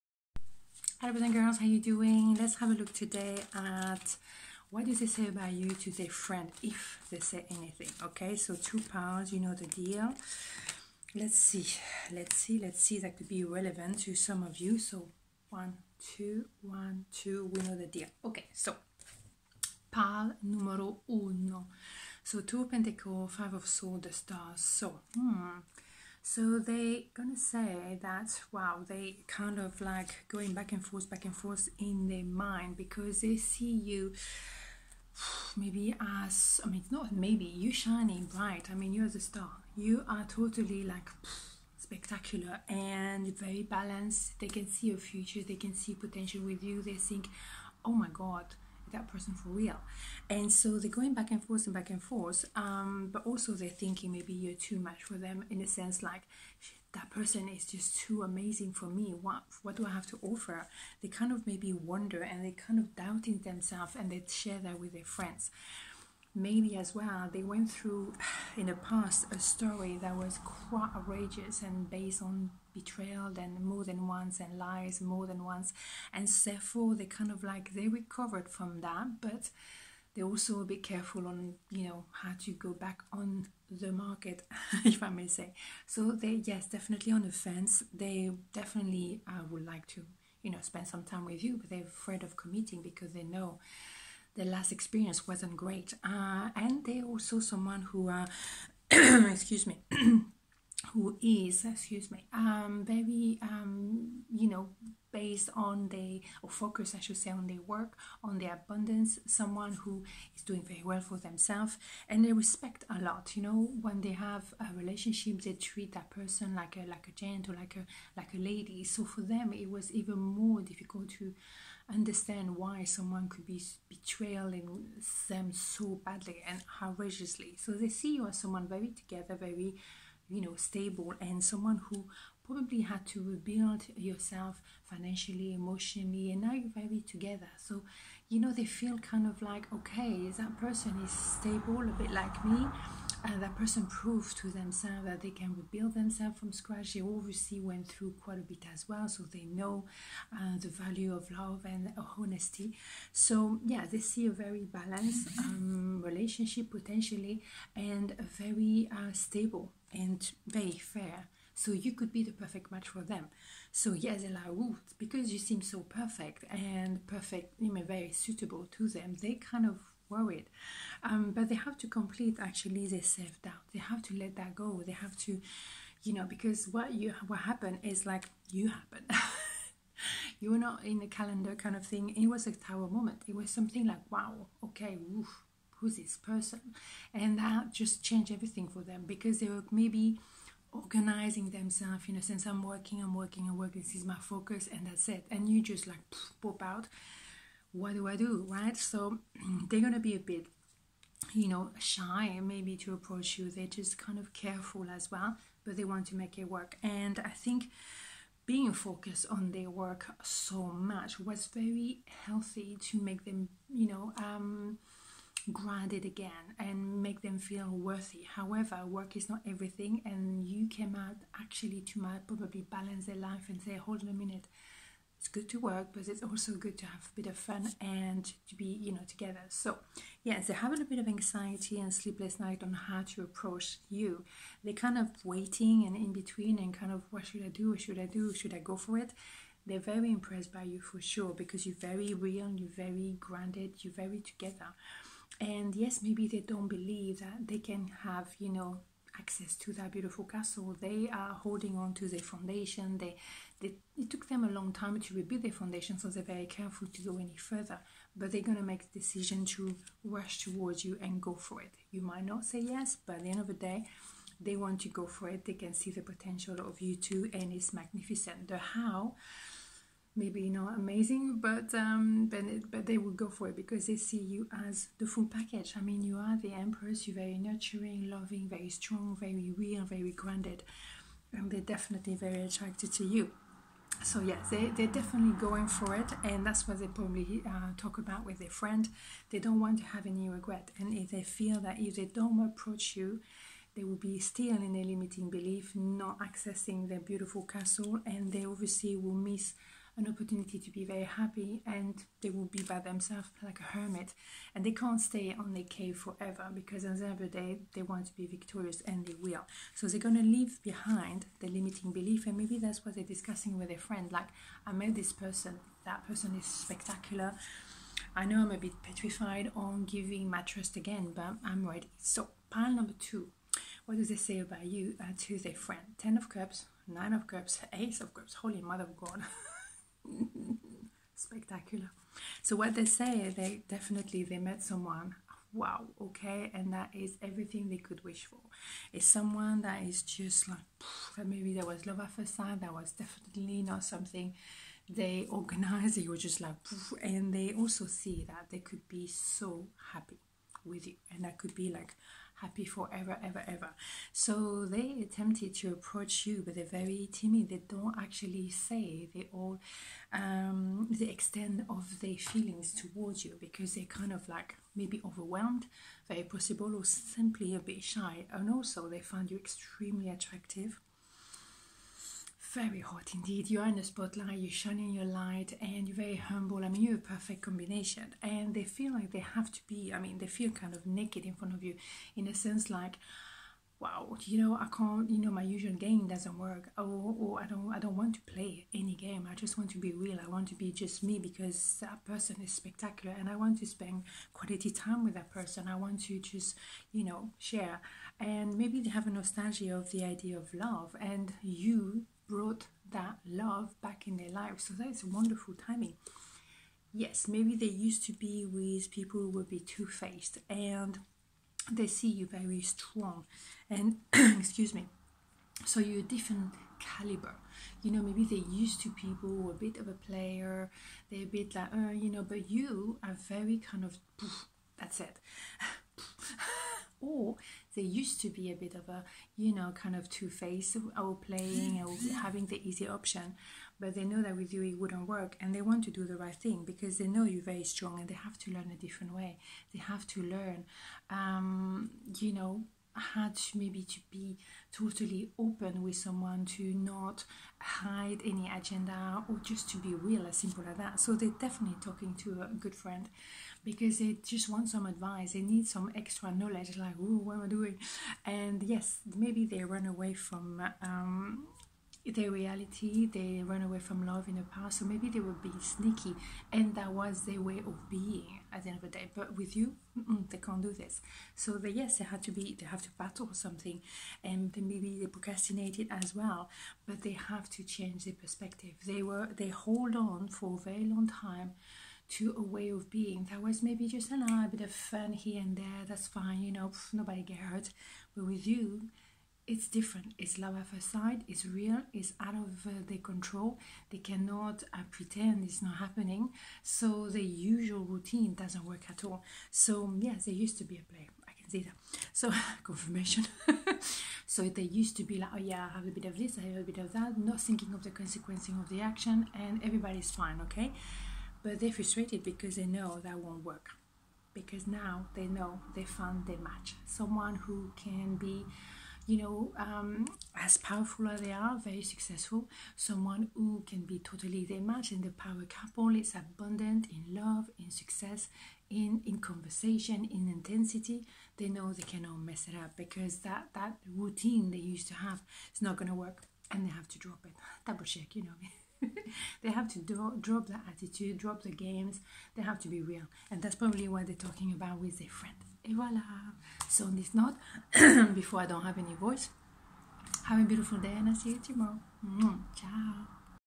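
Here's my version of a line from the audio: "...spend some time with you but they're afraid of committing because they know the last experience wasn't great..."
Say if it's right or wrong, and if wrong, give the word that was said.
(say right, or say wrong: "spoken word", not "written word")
right.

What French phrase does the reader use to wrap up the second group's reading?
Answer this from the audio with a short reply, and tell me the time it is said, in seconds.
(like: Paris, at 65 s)
Et voilà, at 545 s.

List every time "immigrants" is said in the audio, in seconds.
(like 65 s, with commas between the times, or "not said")
not said.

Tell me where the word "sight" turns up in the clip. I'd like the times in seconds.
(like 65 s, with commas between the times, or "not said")
342 s, 490 s.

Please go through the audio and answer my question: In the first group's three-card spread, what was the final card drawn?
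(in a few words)
The Star.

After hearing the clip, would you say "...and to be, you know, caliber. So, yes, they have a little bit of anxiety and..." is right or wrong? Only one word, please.
wrong.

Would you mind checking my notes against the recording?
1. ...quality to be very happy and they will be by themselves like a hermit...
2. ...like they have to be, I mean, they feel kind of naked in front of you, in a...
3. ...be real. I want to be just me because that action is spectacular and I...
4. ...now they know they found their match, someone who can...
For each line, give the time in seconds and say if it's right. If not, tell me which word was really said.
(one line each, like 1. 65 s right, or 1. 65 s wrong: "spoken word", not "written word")
1. 300 s wrong: "opportunity", not "quality"
2. 378 s right
3. 389 s wrong: "person", not "action"
4. 514 s right.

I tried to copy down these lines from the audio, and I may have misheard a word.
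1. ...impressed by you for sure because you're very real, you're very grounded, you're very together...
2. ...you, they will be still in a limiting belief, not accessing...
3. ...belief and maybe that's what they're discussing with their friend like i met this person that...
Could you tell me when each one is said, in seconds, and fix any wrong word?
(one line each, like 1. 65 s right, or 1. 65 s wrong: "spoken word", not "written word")
1. 240 s right
2. 292 s right
3. 311 s right.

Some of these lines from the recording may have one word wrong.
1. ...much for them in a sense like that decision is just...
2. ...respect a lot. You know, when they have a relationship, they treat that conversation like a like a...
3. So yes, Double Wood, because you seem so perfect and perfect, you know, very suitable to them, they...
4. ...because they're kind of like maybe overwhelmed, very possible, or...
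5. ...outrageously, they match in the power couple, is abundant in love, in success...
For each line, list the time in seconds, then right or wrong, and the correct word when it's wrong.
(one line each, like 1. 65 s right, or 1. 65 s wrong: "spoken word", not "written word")
1. 54 s wrong: "person", not "decision"
2. 112 s wrong: "person", not "conversation"
3. 163 s wrong: "Ella", not "Double"
4. 363 s right
5. 523 s wrong: "totally", not "outrageously".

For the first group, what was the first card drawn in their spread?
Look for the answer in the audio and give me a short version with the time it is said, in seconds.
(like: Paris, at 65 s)
Two of Pentacles, at 22 s.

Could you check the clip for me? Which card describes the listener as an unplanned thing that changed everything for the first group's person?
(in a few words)
Tower.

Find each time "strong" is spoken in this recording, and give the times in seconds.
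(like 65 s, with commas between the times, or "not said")
278 s, 412 s, 437 s.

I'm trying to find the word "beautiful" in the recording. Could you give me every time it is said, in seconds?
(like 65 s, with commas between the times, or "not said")
249 s, 296 s, 550 s.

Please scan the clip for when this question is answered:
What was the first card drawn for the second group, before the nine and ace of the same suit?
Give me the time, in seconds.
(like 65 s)
325 s.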